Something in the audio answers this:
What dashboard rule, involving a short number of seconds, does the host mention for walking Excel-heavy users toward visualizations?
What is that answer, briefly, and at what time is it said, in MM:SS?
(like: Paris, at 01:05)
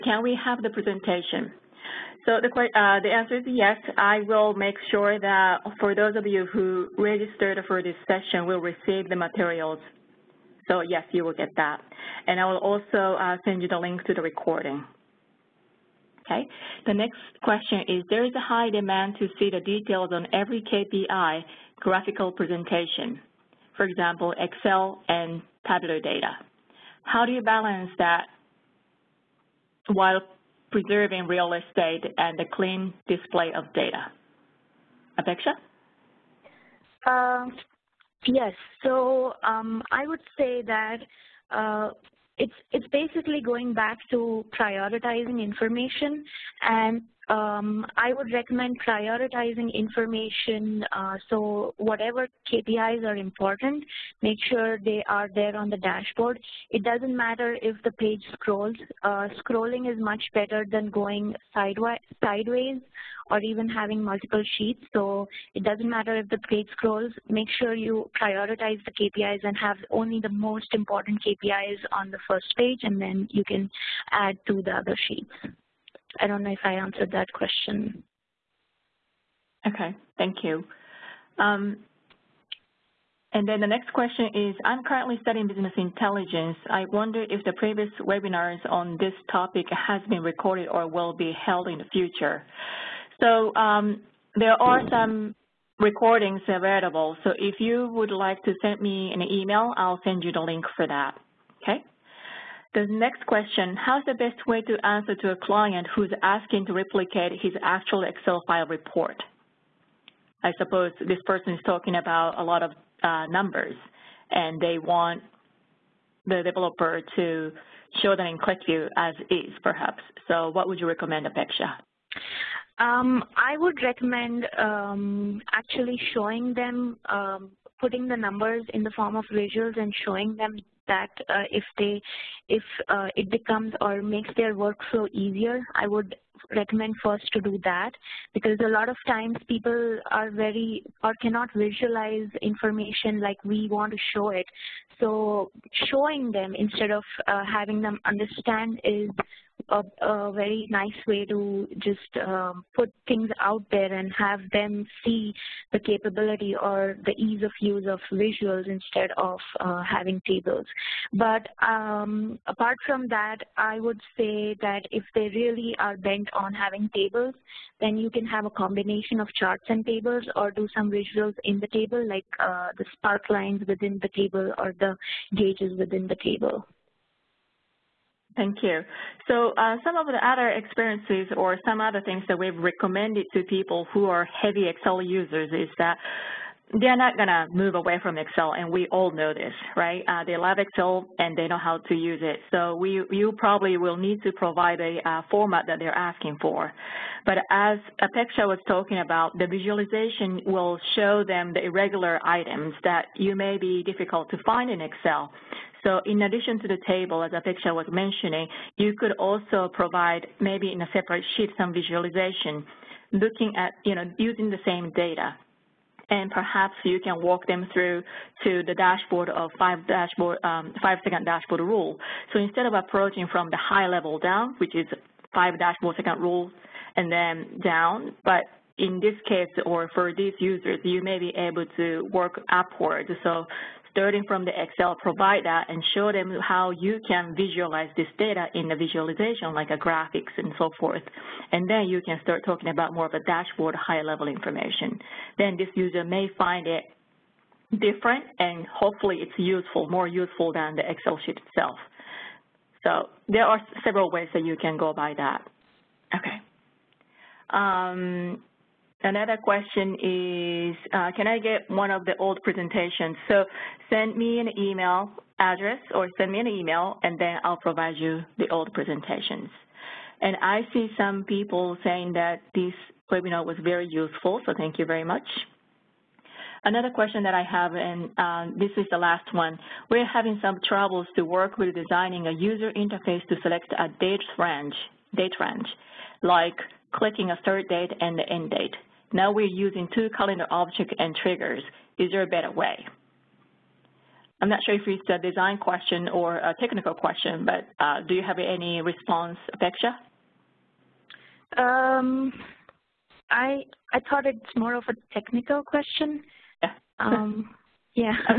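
Five second dashboard rule, at 03:40.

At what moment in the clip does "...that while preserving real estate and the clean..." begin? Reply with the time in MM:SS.
00:27.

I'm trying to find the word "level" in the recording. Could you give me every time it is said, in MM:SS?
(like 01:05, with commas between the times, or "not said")
03:43, 04:03.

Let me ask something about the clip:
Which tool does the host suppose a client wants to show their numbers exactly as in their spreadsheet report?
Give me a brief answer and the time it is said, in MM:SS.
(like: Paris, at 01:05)
QlikView, at 01:58.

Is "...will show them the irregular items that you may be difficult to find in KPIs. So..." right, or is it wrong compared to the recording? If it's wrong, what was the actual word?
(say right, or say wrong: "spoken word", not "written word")
wrong: "Excel", not "KPIs".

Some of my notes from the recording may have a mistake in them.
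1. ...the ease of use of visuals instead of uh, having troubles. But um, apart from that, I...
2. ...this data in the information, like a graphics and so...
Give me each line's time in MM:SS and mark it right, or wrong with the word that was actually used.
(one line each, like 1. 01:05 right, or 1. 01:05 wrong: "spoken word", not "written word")
1. 02:37 wrong: "tables", not "troubles"
2. 03:57 wrong: "visualization", not "information".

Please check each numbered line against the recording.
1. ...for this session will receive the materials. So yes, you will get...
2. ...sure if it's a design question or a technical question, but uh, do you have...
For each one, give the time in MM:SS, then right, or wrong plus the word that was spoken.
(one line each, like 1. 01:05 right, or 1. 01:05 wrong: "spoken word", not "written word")
1. 00:07 right
2. 04:54 right.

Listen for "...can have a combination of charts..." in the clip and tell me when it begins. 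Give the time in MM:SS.
02:48.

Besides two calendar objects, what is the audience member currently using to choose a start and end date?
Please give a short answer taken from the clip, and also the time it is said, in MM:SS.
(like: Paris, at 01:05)
Triggers, at 04:51.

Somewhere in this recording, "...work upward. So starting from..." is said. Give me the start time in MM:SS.
03:52.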